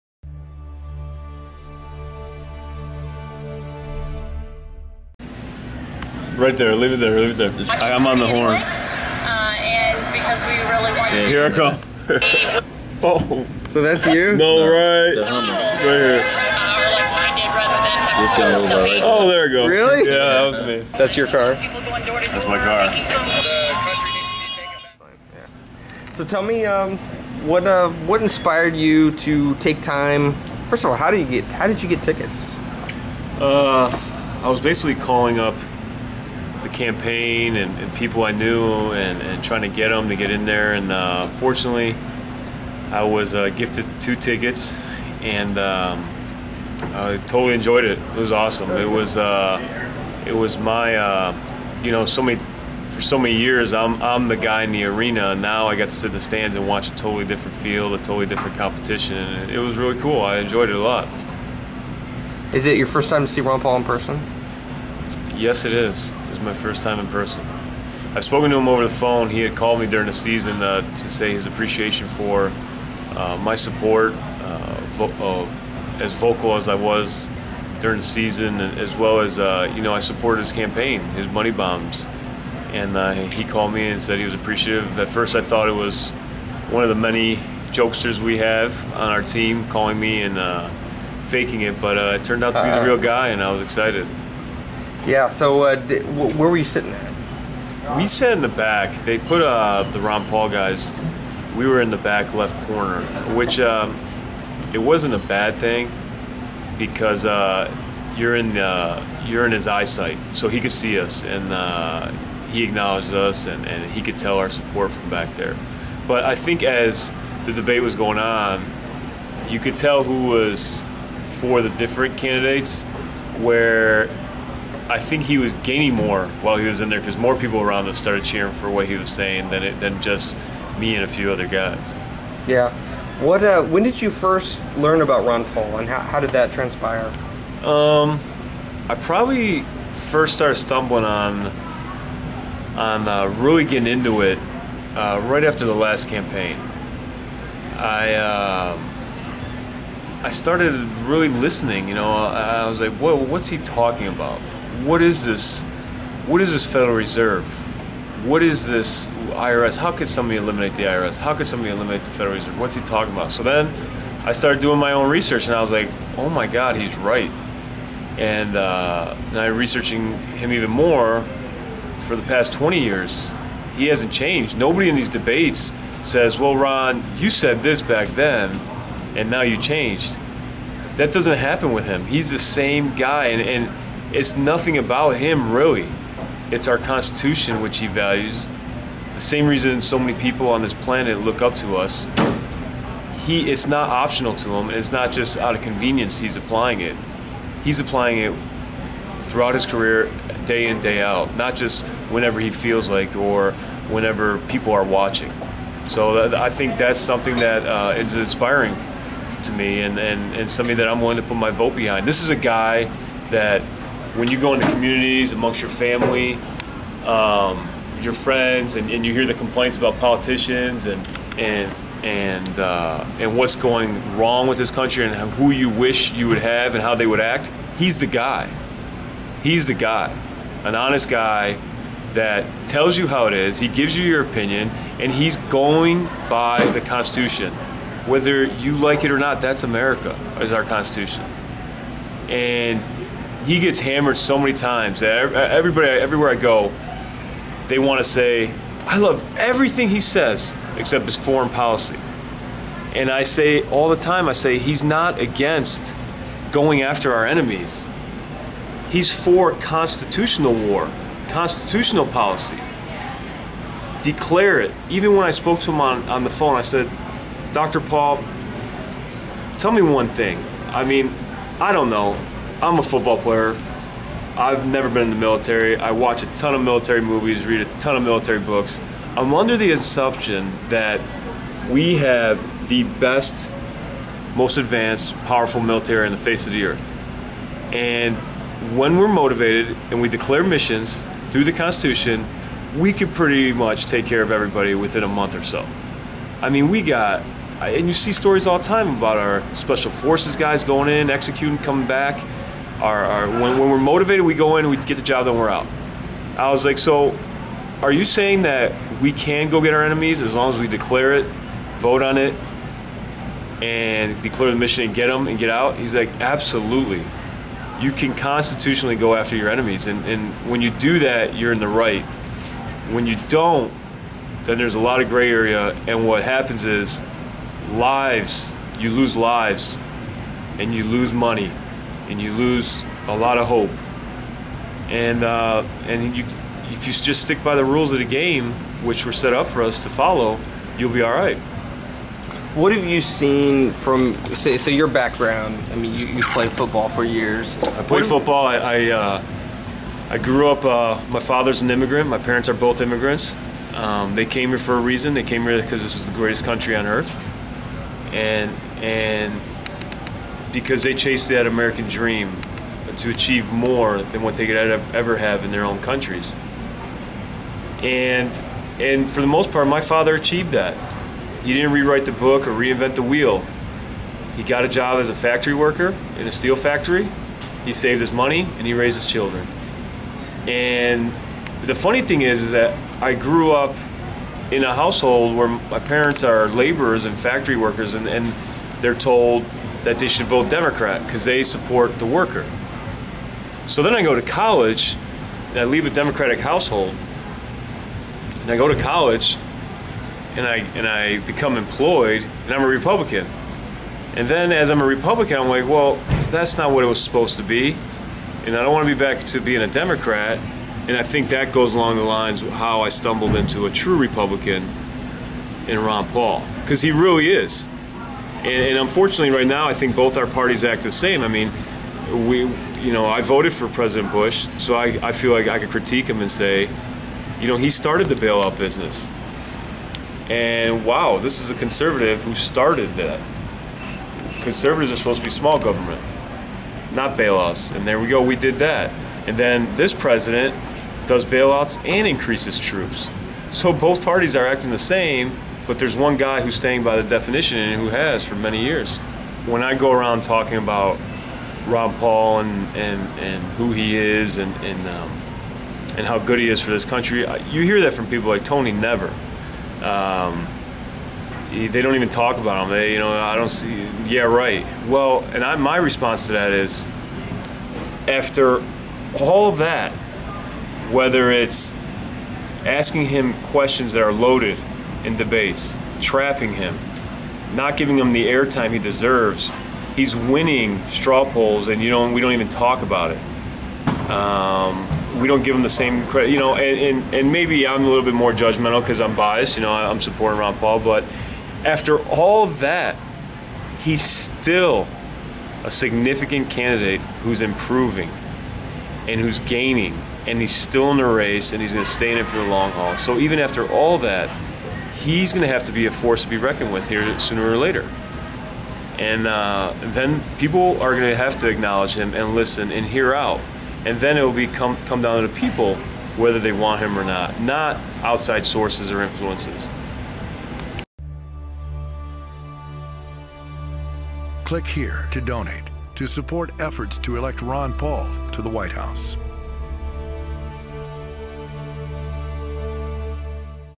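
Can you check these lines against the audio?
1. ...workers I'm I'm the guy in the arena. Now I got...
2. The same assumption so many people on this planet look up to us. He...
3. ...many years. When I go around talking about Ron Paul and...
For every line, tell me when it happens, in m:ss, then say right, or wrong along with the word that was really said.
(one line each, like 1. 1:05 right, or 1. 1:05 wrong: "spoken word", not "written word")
1. 0:53 wrong: "years", not "workers"
2. 3:09 wrong: "reason", not "assumption"
3. 7:28 right.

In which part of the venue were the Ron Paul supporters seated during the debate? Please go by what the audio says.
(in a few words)
back left corner.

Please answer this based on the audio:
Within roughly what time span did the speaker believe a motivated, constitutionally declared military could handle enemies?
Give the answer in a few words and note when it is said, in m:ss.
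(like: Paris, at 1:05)
a month, at 4:55.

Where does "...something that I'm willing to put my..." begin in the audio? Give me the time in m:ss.
3:30.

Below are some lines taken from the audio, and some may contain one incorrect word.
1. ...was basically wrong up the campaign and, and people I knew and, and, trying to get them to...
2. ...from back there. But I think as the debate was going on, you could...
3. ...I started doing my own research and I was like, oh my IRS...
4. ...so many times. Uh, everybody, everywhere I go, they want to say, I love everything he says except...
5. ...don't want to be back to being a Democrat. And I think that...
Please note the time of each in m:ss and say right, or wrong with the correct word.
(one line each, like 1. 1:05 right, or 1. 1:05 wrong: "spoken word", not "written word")
1. 0:34 wrong: "calling", not "wrong"
2. 1:54 right
3. 2:44 wrong: "God", not "IRS"
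4. 4:04 right
5. 6:48 right.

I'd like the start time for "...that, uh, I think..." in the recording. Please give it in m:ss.
3:26.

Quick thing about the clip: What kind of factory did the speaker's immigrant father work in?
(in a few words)
steel factory.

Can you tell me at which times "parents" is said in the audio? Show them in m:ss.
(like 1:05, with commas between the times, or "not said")
5:52, 6:25.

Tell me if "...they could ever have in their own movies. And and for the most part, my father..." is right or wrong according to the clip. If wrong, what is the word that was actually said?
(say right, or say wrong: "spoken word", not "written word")
wrong: "countries", not "movies".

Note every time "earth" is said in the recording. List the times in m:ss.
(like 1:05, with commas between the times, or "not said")
4:46, 5:56.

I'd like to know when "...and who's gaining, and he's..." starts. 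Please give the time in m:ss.
8:19.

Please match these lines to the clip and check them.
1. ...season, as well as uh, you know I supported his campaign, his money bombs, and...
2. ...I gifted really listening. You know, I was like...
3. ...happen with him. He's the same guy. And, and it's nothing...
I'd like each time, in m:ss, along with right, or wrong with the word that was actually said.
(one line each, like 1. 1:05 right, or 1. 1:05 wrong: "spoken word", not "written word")
1. 1:18 right
2. 2:30 wrong: "started", not "gifted"
3. 3:01 right.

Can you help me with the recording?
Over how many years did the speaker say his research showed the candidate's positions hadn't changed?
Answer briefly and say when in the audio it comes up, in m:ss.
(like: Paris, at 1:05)
20 years, at 2:52.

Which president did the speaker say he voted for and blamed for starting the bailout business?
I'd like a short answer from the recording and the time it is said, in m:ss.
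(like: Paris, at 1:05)
President Bush, at 7:03.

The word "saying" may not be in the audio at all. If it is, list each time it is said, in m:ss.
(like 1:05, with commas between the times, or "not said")
2:09, 5:08.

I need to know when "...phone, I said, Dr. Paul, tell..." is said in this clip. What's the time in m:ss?
4:26.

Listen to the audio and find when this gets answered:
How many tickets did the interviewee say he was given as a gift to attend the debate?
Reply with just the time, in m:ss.
0:43.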